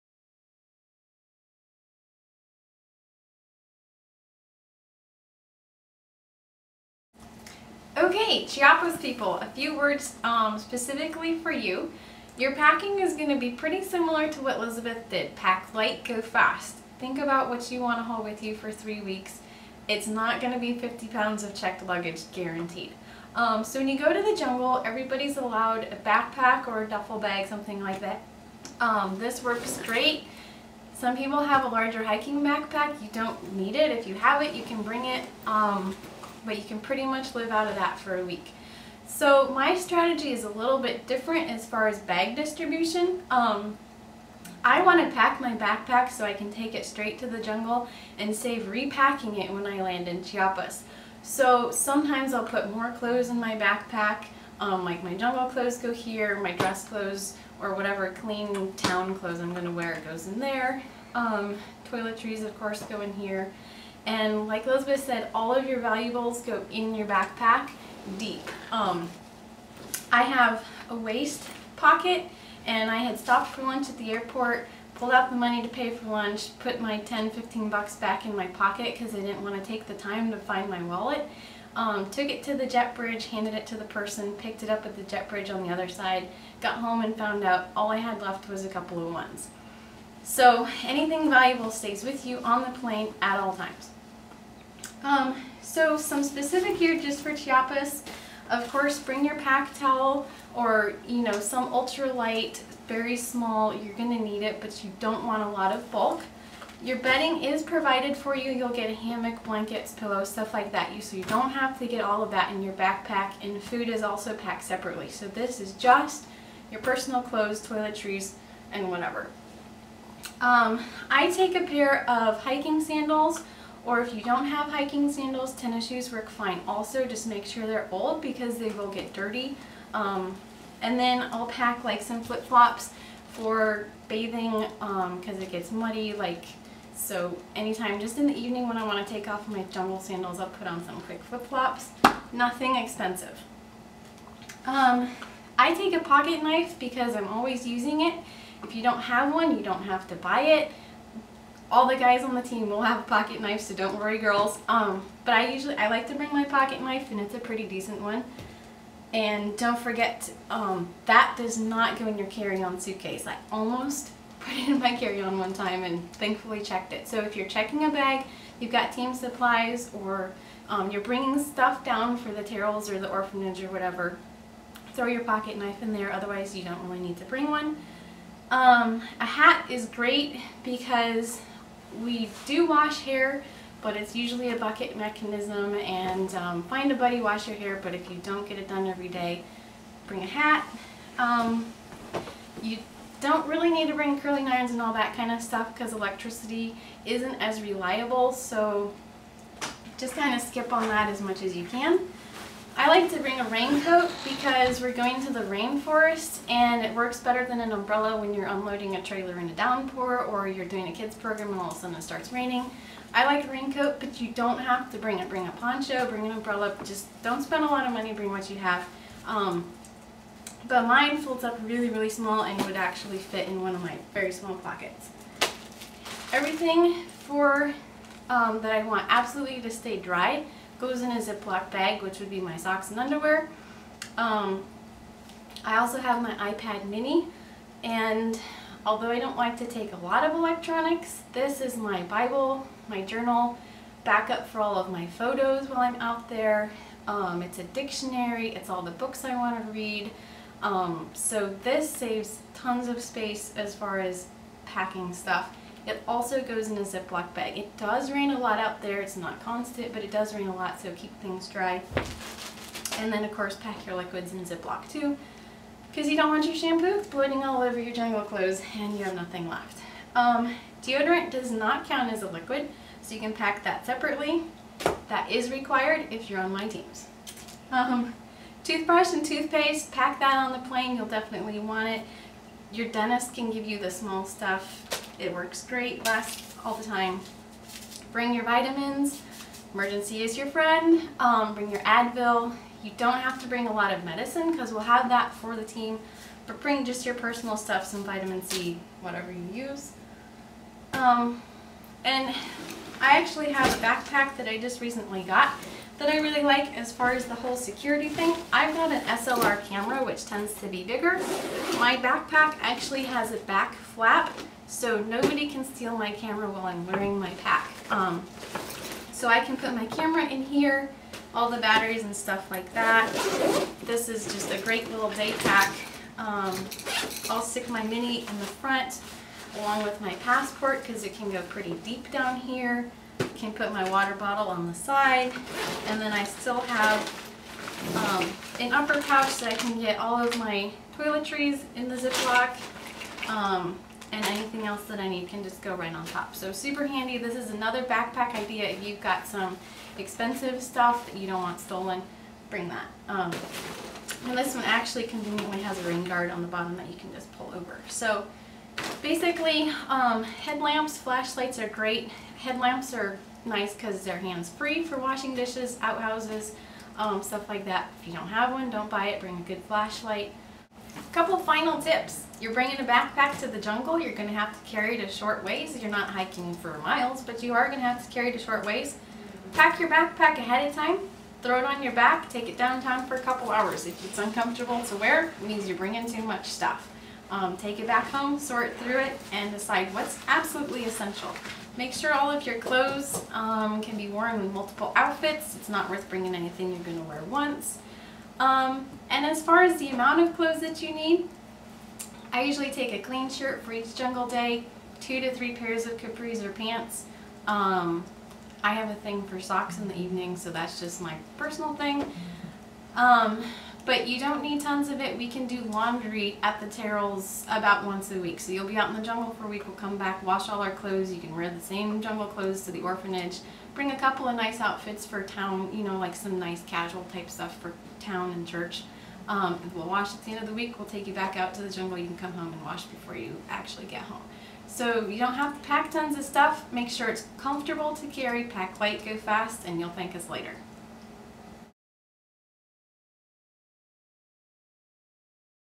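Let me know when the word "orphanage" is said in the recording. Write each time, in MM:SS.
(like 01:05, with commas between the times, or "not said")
02:53, 07:02.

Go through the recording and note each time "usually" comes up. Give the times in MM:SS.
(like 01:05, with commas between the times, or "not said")
02:35, 03:04, 06:42.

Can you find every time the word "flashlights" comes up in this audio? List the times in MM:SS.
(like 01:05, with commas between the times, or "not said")
06:00, 06:09.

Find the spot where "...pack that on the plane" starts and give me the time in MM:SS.
04:39.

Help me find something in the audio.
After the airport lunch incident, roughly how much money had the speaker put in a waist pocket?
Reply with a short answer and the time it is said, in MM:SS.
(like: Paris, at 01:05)
10, 15 bucks, at 01:16.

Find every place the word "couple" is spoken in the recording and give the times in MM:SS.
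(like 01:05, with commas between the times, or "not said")
01:28, 06:11, 06:23, 07:03.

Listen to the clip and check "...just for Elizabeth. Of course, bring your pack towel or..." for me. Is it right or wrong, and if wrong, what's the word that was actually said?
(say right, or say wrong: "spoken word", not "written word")
wrong: "Chiapas", not "Elizabeth".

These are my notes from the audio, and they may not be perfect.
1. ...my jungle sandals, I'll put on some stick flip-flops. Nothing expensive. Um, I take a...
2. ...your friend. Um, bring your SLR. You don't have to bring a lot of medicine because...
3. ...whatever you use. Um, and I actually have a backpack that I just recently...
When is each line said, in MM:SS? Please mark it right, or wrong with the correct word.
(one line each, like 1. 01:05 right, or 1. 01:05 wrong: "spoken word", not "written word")
1. 02:19 wrong: "quick", not "stick"
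2. 04:50 wrong: "Advil", not "SLR"
3. 04:59 right.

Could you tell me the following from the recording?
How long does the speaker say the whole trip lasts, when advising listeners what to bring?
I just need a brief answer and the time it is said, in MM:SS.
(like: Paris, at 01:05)
3 weeks, at 00:18.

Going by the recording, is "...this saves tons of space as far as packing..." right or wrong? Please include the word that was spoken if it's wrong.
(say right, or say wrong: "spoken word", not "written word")
right.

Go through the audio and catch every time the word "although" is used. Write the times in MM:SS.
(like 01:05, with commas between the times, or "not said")
03:58.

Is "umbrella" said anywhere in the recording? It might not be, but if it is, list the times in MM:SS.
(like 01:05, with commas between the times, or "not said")
03:27, 03:36.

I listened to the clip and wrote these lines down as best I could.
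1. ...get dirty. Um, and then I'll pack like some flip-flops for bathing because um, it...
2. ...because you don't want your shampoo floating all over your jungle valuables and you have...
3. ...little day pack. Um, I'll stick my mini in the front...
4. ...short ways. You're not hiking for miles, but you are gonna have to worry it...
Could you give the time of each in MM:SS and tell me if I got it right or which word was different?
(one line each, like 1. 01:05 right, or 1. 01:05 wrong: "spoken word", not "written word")
1. 02:08 right
2. 04:25 wrong: "clothes", not "valuables"
3. 05:24 right
4. 06:15 wrong: "carry", not "worry".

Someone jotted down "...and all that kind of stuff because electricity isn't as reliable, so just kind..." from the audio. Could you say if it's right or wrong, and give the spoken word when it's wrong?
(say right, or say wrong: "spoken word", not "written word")
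right.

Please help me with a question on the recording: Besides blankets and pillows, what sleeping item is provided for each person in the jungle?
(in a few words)
Hammock.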